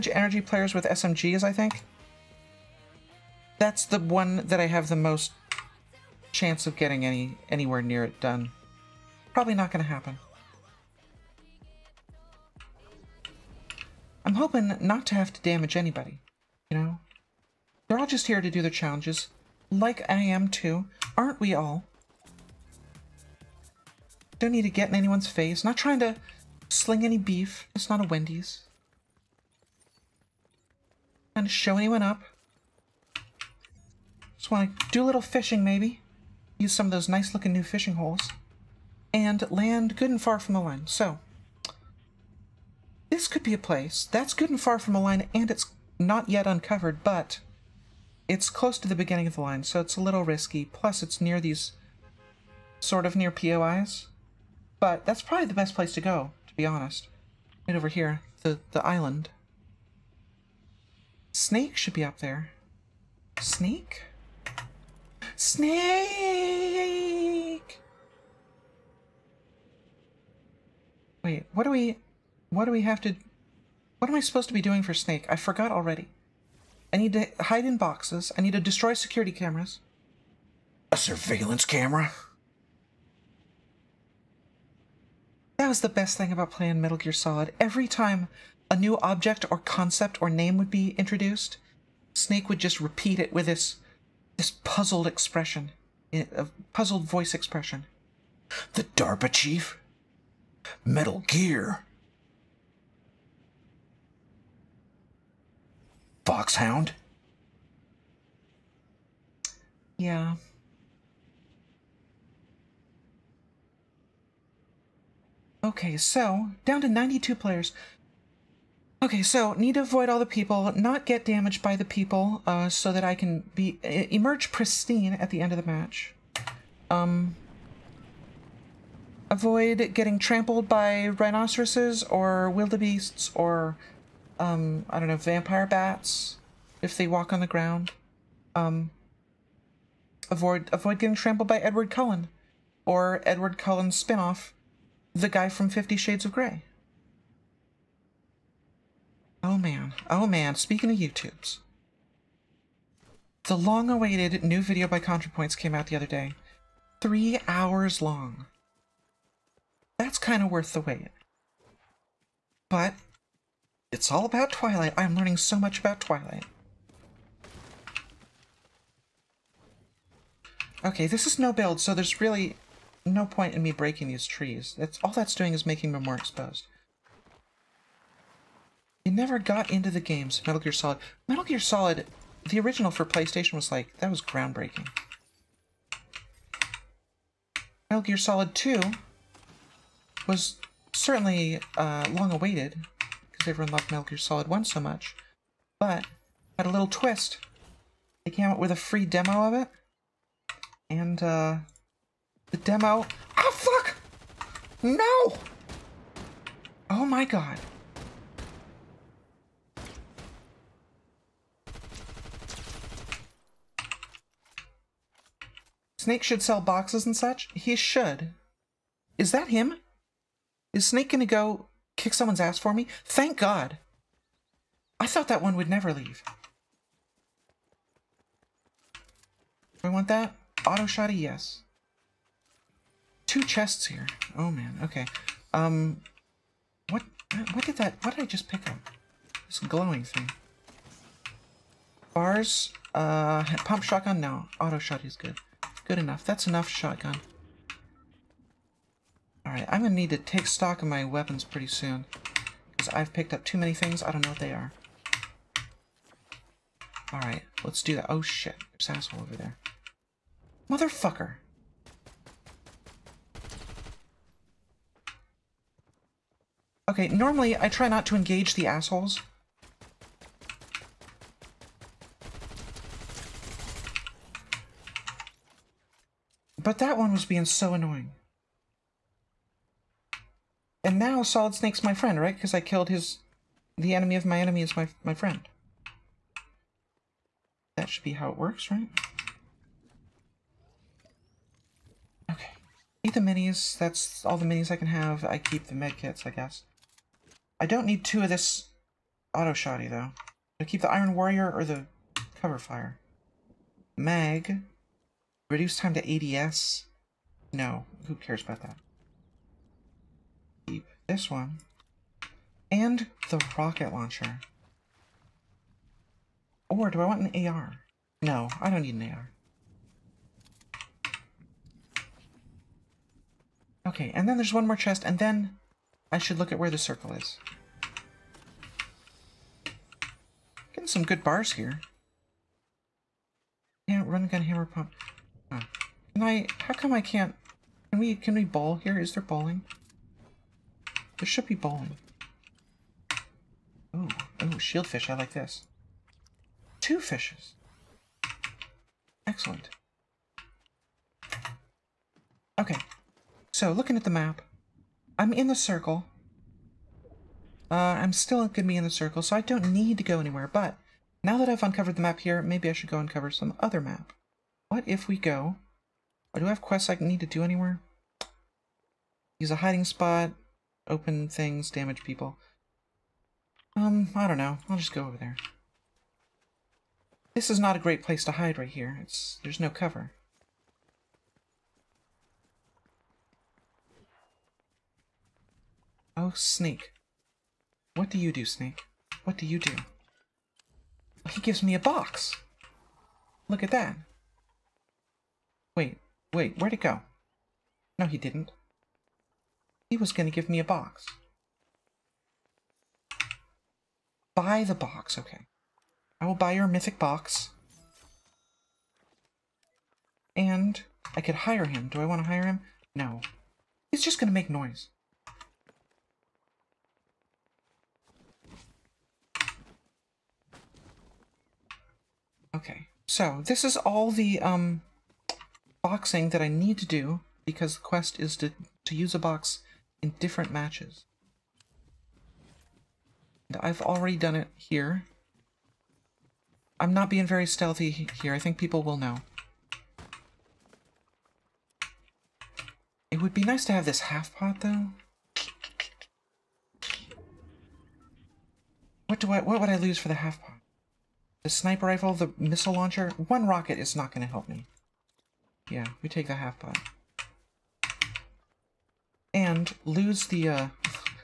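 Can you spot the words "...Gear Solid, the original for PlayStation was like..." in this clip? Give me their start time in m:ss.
3:01.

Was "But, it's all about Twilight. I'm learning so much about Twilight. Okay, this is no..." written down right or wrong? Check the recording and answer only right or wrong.
right.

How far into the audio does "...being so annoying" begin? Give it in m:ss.
4:37.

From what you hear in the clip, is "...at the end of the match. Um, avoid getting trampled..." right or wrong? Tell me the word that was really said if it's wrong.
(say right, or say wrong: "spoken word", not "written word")
right.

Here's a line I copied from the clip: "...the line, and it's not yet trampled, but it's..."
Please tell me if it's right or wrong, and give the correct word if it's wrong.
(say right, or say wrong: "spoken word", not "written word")
wrong: "uncovered", not "trampled".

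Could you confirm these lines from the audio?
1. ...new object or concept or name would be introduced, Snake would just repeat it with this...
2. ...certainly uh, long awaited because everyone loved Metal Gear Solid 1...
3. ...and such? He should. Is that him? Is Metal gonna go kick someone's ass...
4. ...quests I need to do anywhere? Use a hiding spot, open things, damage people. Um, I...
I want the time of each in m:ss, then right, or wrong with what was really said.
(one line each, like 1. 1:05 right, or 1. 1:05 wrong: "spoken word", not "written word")
1. 1:28 right
2. 3:10 right
3. 3:37 wrong: "Snake", not "Metal"
4. 6:06 right.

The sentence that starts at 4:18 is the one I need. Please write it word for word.
Oh shit, there's an asshole over there.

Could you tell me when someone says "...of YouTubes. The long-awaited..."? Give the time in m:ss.
2:30.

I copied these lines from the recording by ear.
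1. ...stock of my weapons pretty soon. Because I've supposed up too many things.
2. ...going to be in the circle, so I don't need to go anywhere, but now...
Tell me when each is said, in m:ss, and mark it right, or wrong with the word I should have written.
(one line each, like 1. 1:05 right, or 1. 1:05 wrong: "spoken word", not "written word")
1. 4:10 wrong: "picked", not "supposed"
2. 5:58 right.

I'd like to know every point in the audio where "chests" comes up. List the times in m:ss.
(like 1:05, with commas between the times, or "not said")
3:53, 5:24.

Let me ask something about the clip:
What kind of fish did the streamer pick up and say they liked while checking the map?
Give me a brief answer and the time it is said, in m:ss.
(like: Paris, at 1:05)
Shield fish, at 5:44.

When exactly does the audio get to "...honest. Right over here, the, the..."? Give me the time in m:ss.
0:56.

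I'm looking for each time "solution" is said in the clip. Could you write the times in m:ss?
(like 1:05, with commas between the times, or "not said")
not said.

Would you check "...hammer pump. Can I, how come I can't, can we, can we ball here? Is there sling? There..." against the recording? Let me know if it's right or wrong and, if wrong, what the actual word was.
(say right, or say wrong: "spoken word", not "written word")
wrong: "balling", not "sling".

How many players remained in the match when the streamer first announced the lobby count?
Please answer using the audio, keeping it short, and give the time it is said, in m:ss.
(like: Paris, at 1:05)
92, at 1:56.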